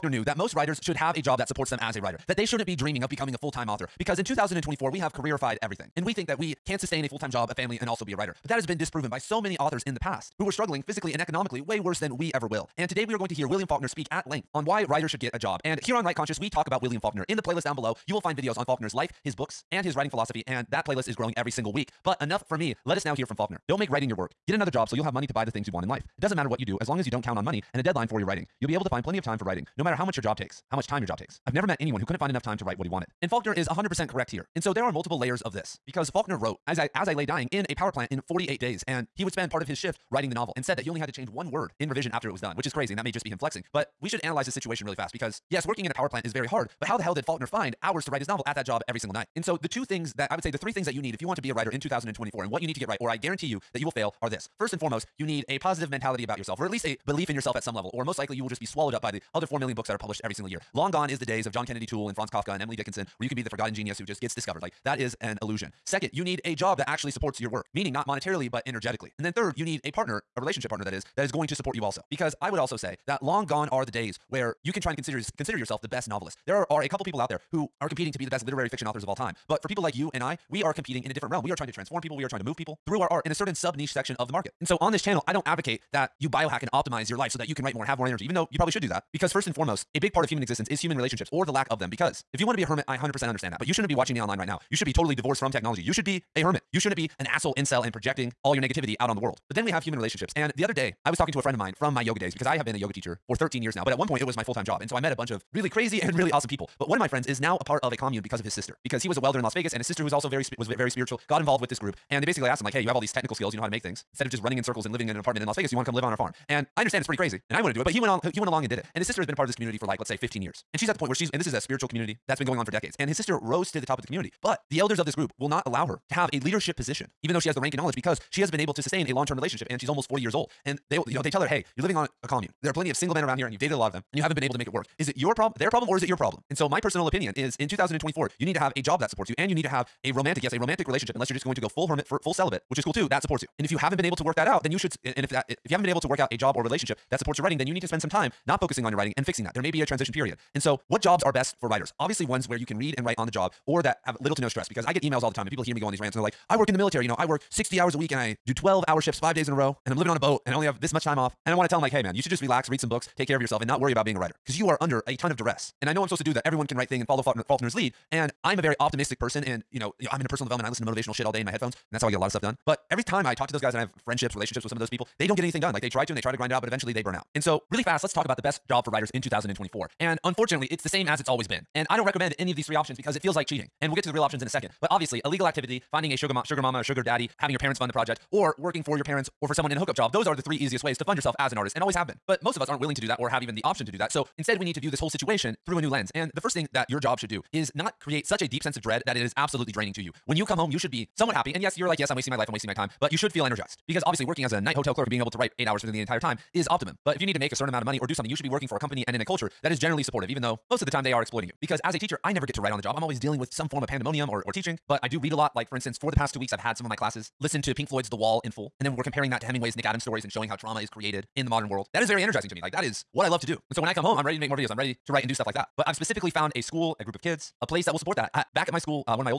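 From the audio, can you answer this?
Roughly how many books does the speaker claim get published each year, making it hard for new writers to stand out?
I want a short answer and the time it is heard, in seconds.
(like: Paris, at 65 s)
4 million, at 59 s.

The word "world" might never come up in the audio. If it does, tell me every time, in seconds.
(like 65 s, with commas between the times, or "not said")
99 s, 221 s.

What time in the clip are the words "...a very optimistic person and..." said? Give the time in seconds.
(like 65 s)
168 s.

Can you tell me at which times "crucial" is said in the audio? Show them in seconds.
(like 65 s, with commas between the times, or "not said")
not said.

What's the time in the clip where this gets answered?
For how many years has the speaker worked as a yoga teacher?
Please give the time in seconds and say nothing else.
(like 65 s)
103 s.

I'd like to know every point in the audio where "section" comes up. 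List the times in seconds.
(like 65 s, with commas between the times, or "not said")
83 s.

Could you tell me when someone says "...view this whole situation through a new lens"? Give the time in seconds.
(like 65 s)
194 s.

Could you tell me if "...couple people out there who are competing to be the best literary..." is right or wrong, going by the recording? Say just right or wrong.
right.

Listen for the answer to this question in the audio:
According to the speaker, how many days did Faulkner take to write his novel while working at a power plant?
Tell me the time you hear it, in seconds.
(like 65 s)
38 s.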